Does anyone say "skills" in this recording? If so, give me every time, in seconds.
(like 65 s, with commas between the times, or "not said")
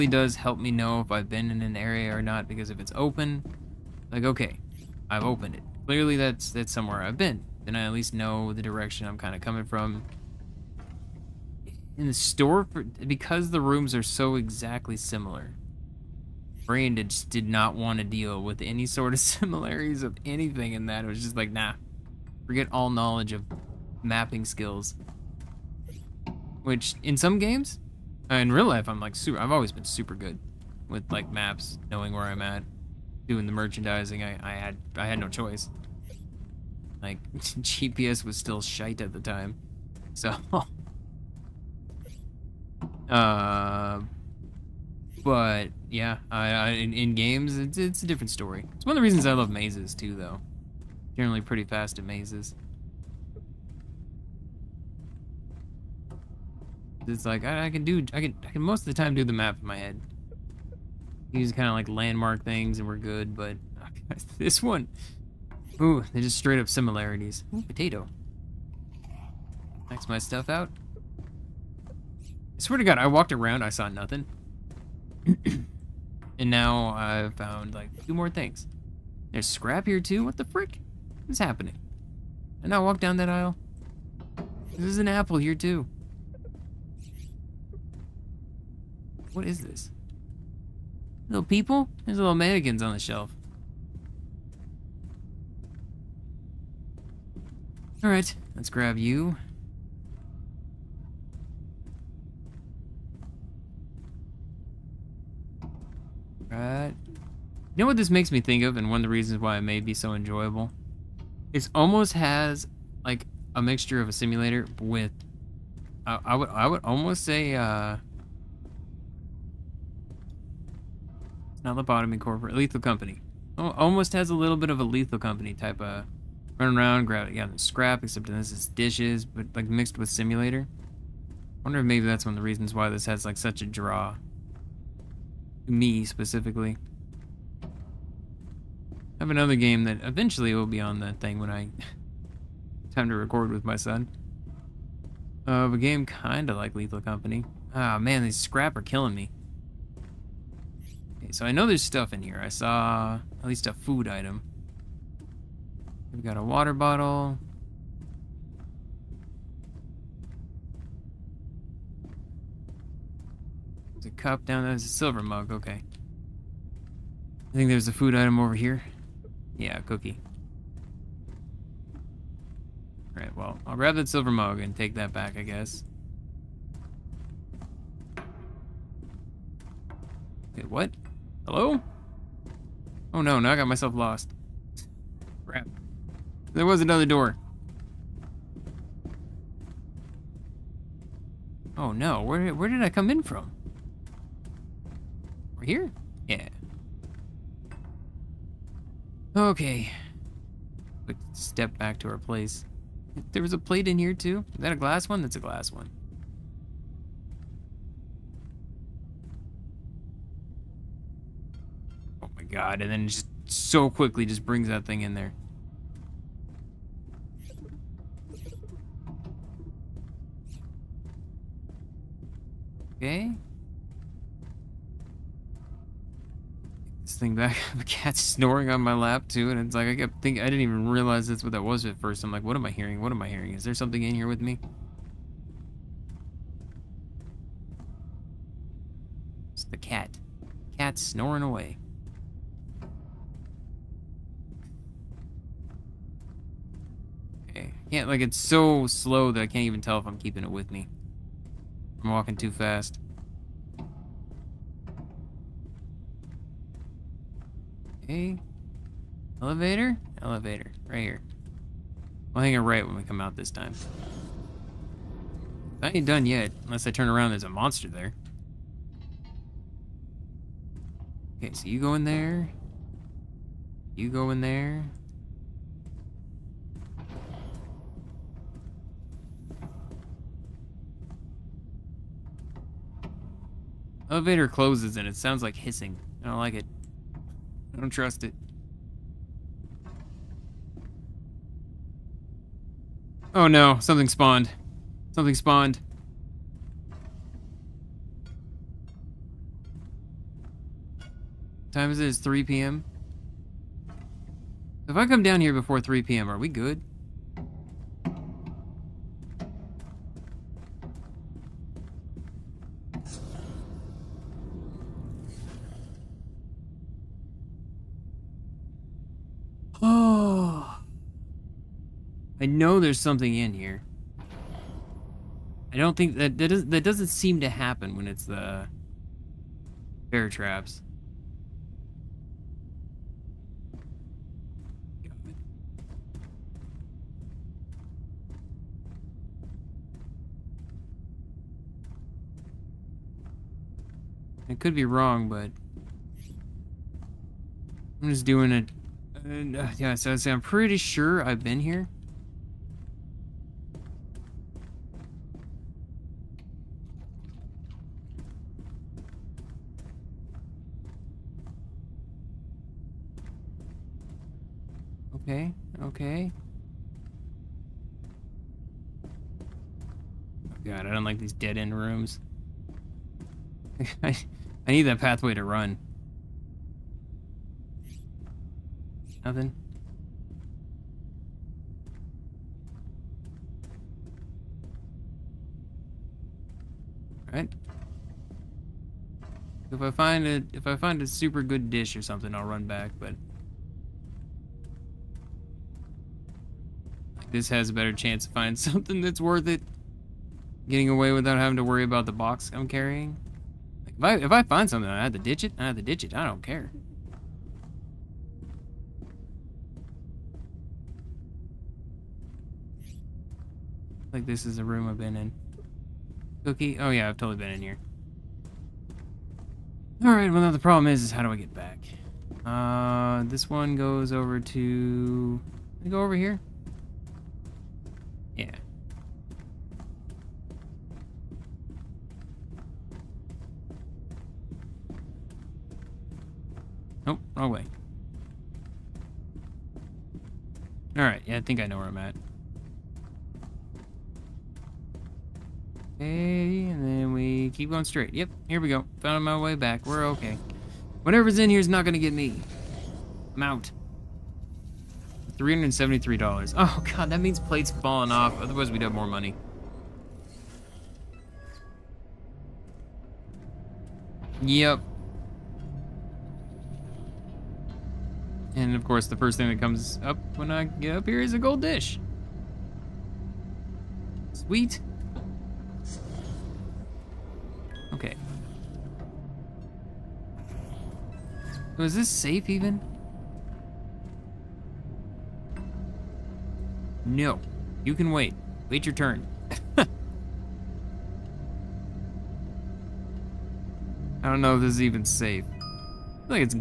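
24 s.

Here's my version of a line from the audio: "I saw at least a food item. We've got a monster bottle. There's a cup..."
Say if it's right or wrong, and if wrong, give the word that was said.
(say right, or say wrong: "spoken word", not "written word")
wrong: "water", not "monster".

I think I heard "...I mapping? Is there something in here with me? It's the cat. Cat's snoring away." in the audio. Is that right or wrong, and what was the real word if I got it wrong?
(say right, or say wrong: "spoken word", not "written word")
wrong: "hearing", not "mapping".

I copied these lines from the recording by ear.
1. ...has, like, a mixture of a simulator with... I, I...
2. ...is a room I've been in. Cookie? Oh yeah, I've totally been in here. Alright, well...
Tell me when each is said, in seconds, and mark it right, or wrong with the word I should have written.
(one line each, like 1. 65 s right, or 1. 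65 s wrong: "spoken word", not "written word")
1. 112 s right
2. 414 s right.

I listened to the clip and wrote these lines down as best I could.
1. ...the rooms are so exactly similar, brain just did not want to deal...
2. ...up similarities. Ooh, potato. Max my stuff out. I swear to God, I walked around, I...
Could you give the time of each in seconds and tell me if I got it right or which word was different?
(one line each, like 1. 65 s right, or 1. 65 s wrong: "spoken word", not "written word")
1. 13 s right
2. 66 s right.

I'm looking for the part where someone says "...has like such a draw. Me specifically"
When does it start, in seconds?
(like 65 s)
133 s.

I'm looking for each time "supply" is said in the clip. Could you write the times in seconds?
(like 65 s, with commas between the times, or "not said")
not said.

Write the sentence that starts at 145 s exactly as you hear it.
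Of uh, a game kinda like Lethal Company.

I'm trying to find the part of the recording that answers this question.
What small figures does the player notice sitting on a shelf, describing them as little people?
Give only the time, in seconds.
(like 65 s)
92 s.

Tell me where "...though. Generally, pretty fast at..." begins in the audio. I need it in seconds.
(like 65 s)
50 s.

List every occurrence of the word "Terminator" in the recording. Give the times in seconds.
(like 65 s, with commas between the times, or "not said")
not said.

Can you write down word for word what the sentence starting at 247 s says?
Yeah, like it's so slow that I can't even tell if I'm keeping it with me.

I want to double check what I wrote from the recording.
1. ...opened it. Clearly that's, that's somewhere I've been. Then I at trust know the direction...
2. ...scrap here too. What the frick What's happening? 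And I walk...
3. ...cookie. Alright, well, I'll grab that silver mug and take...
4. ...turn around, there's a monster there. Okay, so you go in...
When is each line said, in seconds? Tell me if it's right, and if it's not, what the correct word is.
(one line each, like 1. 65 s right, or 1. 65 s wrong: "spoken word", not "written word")
1. 5 s wrong: "least", not "trust"
2. 79 s right
3. 169 s right
4. 266 s right.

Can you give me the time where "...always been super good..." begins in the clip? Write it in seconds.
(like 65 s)
29 s.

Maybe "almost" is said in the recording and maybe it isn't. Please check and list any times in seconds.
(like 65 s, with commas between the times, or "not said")
111 s, 116 s, 123 s.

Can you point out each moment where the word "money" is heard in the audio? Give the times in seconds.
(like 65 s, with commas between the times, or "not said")
459 s.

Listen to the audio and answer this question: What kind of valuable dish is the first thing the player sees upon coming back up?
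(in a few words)
gold dish.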